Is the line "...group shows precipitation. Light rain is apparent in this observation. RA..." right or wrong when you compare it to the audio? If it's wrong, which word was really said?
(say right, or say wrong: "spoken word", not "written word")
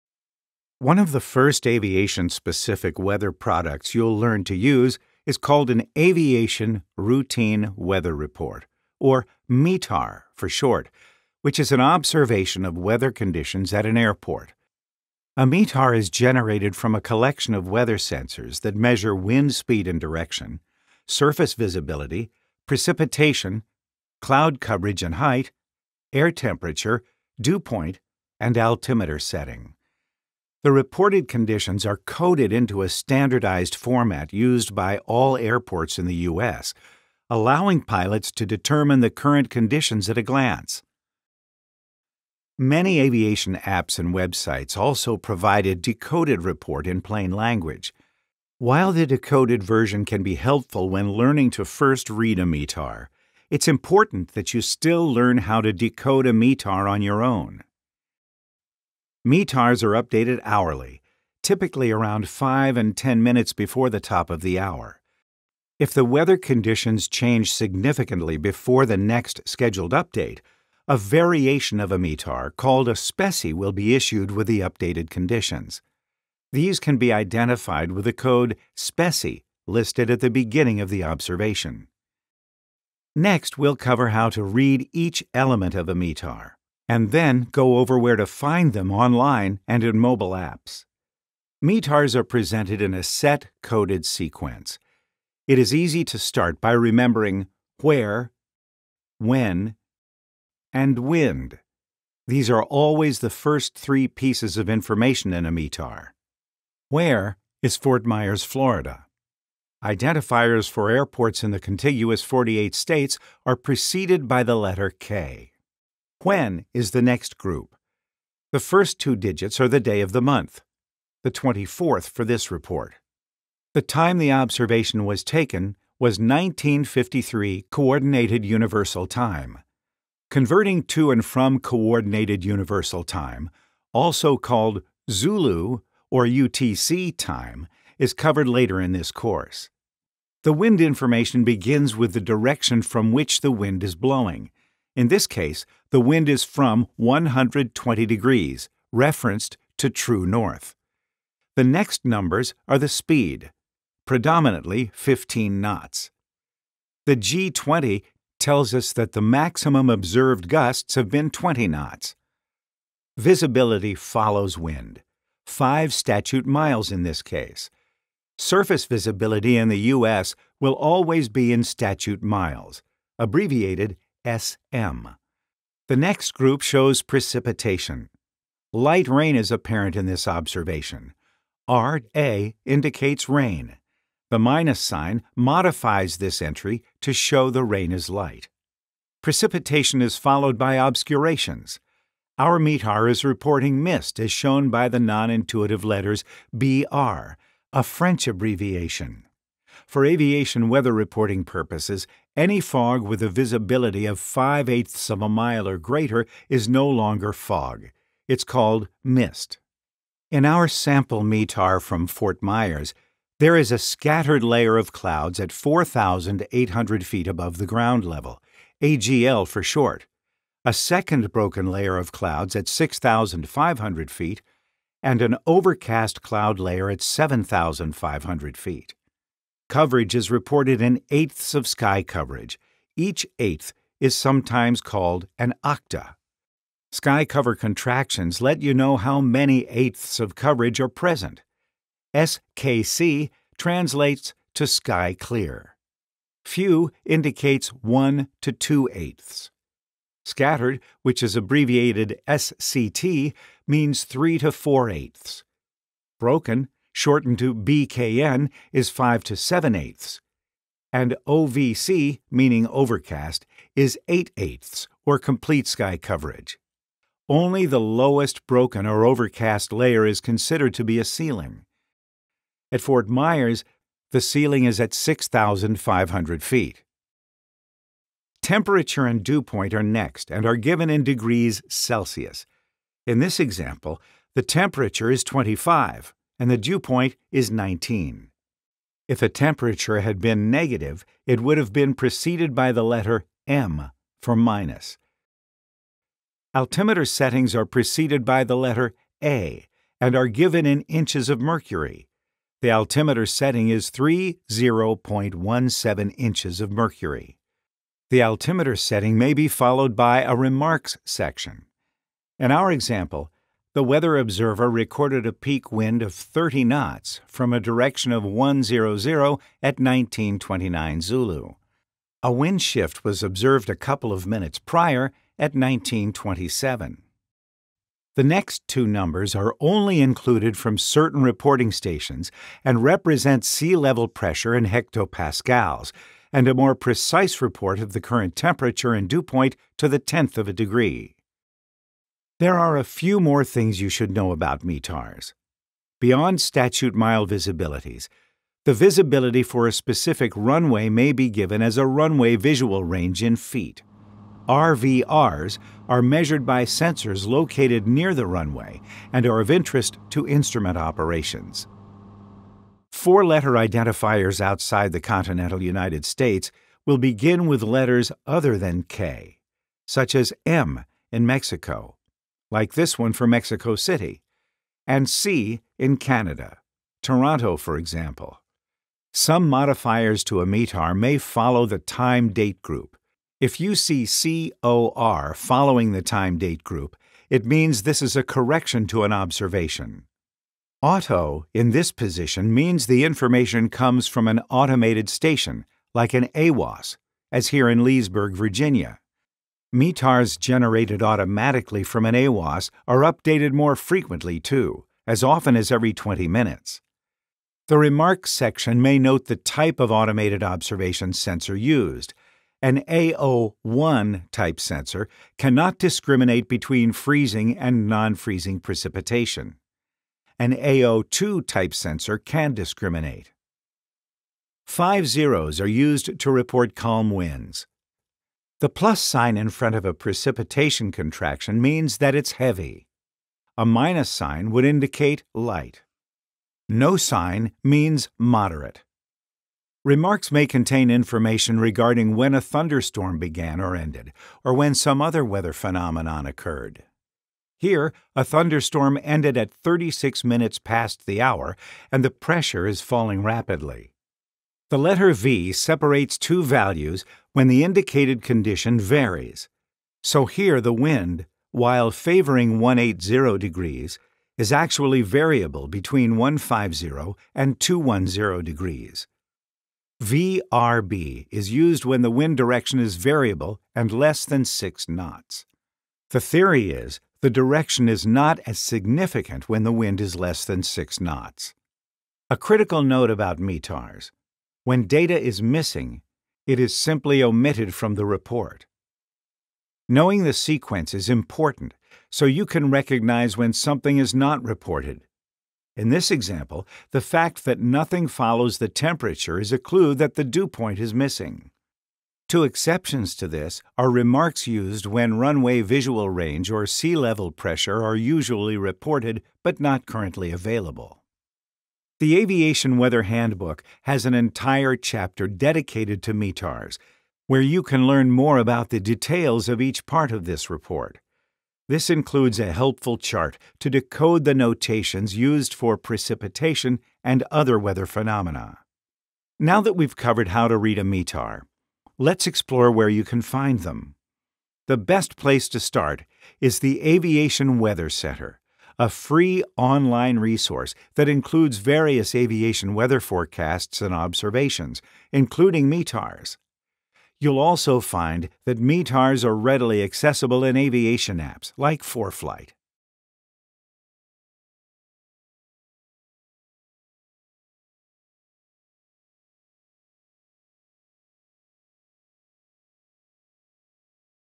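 right.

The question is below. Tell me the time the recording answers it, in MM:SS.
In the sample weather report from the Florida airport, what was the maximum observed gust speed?
02:41.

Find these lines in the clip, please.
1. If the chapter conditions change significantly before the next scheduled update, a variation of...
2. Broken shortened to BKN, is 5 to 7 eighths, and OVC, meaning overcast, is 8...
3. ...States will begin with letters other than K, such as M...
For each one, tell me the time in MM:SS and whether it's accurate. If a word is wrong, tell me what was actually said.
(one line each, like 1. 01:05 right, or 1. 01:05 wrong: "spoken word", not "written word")
1. 01:05 wrong: "weather", not "chapter"
2. 04:16 right
3. 06:06 right.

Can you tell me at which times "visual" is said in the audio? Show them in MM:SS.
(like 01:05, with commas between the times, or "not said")
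05:52, 08:25.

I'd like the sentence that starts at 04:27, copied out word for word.
Only the lowest broken or overcast layer is considered to be a ceiling.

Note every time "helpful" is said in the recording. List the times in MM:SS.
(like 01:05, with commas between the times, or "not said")
00:50, 08:42.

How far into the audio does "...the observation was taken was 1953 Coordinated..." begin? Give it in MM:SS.
02:04.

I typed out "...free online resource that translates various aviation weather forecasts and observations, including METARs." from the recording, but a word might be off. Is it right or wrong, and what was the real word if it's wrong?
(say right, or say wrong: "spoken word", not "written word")
wrong: "includes", not "translates".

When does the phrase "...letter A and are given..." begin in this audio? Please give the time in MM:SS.
04:58.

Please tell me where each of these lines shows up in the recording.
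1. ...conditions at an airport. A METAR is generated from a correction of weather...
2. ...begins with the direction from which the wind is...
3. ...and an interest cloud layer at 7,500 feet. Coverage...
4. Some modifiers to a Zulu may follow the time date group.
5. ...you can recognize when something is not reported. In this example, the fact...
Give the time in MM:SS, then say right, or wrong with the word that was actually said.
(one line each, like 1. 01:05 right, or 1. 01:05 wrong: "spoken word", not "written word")
1. 00:13 wrong: "collection", not "correction"
2. 02:21 right
3. 03:45 wrong: "overcast", not "interest"
4. 06:19 wrong: "METAR", not "Zulu"
5. 08:12 right.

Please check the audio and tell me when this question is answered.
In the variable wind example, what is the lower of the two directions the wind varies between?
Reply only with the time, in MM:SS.
07:46.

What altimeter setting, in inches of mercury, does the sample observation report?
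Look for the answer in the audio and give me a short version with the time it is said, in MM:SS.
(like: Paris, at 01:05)
30.17, at 05:03.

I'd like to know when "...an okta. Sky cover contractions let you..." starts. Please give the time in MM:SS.
03:55.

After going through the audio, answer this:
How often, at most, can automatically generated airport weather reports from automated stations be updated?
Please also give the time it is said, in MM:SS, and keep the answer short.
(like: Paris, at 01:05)
every 20 minutes, at 06:45.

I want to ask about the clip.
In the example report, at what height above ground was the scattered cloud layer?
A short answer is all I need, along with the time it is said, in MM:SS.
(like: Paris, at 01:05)
4,800 feet, at 03:35.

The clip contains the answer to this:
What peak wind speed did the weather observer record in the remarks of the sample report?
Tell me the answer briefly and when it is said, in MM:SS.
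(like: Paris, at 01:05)
30 knots, at 05:16.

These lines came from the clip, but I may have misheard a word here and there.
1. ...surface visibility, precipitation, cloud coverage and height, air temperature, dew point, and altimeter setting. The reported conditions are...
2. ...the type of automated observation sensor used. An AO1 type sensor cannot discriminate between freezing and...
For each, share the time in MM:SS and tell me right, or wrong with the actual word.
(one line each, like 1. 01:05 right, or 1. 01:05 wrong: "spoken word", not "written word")
1. 00:21 right
2. 06:49 right.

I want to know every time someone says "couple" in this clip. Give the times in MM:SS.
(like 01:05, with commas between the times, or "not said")
05:23.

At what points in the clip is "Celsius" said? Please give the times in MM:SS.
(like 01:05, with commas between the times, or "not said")
04:41.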